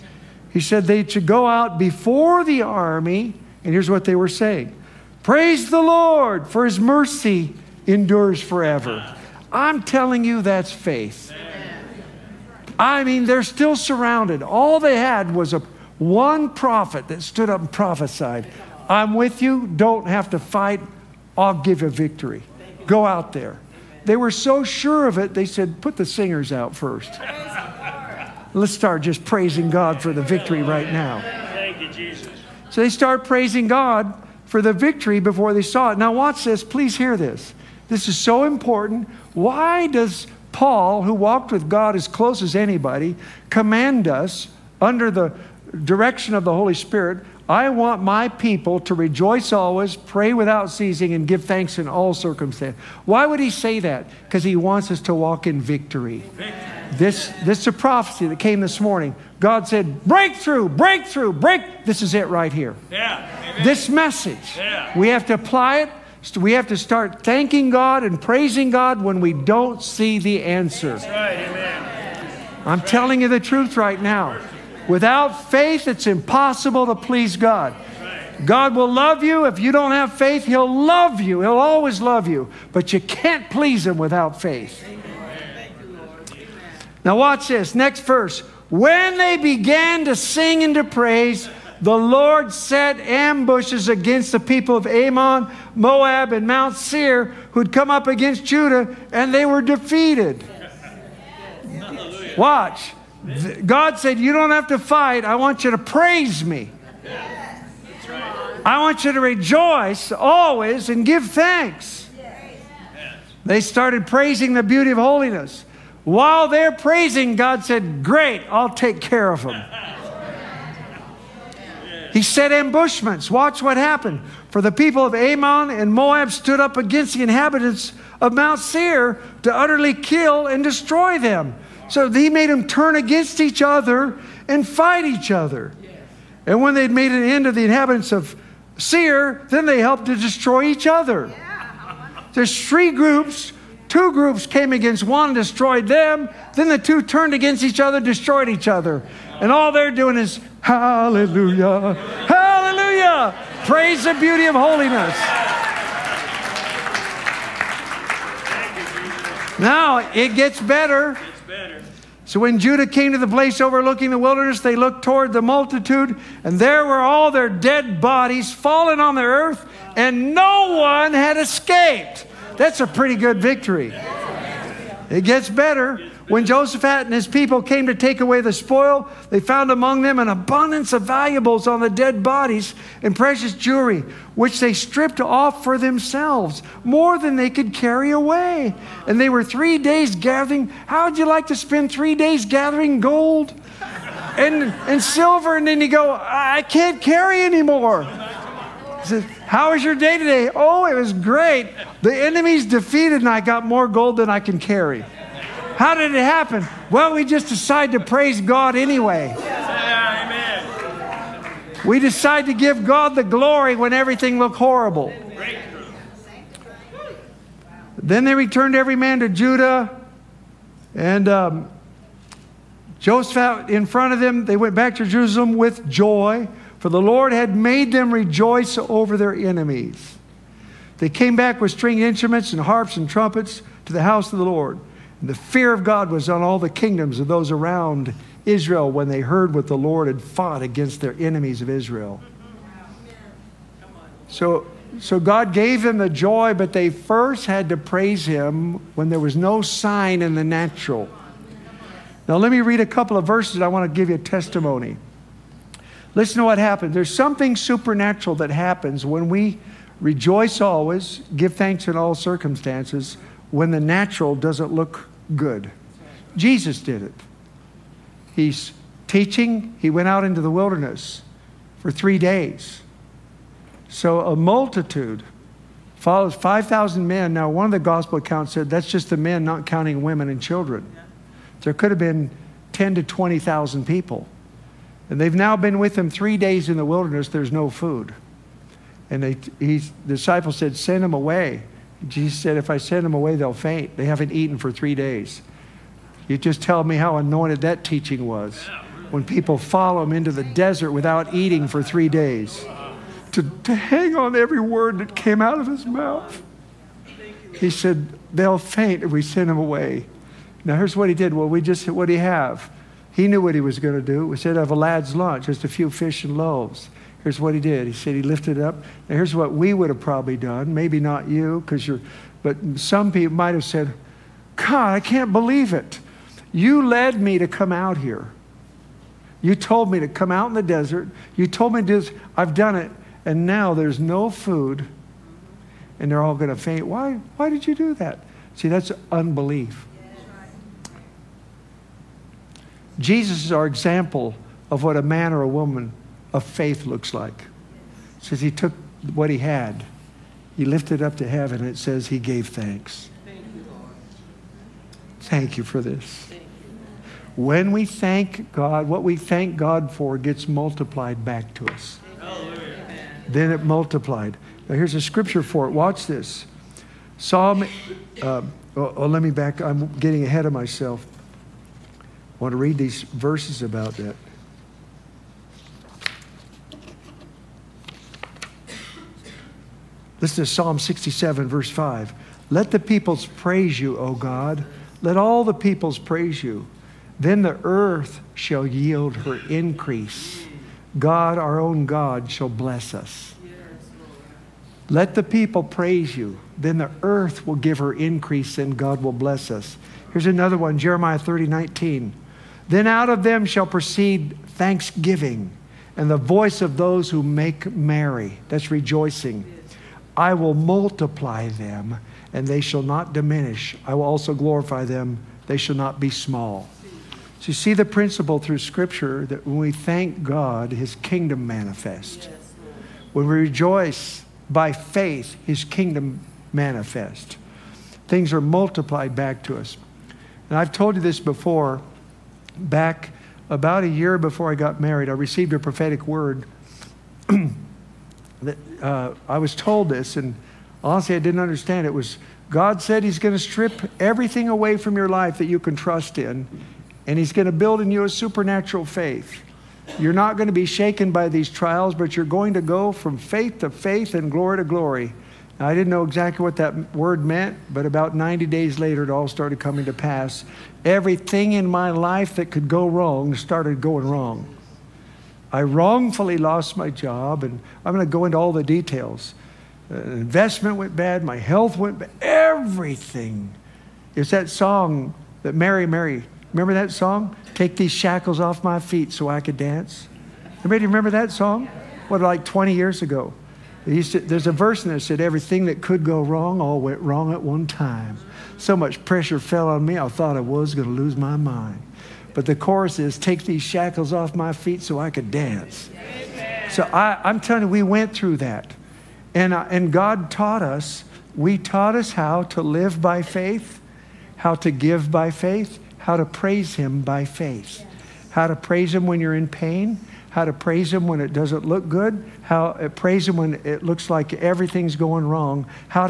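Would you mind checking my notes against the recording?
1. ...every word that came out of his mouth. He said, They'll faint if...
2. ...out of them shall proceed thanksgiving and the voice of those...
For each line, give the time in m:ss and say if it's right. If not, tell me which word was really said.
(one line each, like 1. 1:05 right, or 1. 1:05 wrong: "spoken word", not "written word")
1. 5:04 right
2. 6:42 right.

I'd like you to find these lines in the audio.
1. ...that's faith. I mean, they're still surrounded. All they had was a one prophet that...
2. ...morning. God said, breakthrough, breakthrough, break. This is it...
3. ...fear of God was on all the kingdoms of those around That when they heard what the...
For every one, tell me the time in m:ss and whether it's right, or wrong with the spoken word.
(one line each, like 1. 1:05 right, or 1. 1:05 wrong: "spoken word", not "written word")
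1. 0:10 right
2. 0:58 right
3. 3:55 wrong: "Israel", not "That".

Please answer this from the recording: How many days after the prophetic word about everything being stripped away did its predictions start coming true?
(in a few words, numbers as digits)
90 days.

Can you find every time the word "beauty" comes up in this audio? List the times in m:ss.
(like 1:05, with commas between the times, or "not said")
1:54, 2:34.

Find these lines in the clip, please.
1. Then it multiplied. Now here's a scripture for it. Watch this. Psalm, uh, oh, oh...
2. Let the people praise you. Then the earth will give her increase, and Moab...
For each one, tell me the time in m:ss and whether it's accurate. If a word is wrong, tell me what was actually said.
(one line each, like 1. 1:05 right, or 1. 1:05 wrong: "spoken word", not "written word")
1. 6:03 right
2. 6:34 wrong: "God", not "Moab".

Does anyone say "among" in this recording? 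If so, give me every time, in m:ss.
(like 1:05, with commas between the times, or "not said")
2:59.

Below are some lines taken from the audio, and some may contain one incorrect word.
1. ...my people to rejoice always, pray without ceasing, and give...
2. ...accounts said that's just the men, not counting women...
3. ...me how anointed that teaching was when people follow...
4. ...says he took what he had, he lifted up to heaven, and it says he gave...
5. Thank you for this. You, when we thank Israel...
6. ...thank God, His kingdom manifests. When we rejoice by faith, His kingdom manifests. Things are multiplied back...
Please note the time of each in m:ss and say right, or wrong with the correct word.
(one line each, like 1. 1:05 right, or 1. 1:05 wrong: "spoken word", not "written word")
1. 0:48 right
2. 4:38 right
3. 4:56 right
4. 5:48 right
5. 5:55 wrong: "God", not "Israel"
6. 6:59 right.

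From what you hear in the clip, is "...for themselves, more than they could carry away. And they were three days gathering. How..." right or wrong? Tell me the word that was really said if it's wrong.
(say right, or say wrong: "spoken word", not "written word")
right.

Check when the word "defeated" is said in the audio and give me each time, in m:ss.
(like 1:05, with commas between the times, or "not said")
1:39, 3:22.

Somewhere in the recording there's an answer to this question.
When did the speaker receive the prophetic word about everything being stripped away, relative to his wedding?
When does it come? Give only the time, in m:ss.
7:13.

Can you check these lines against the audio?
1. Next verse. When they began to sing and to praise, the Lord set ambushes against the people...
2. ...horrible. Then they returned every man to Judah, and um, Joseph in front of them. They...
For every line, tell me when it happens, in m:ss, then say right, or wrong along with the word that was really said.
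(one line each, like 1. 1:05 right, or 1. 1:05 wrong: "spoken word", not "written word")
1. 1:27 right
2. 3:34 right.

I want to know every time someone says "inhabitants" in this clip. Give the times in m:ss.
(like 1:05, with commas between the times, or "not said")
2:07, 2:17.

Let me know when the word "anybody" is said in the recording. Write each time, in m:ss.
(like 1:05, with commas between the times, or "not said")
0:42, 8:00.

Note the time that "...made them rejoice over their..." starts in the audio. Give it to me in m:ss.
3:47.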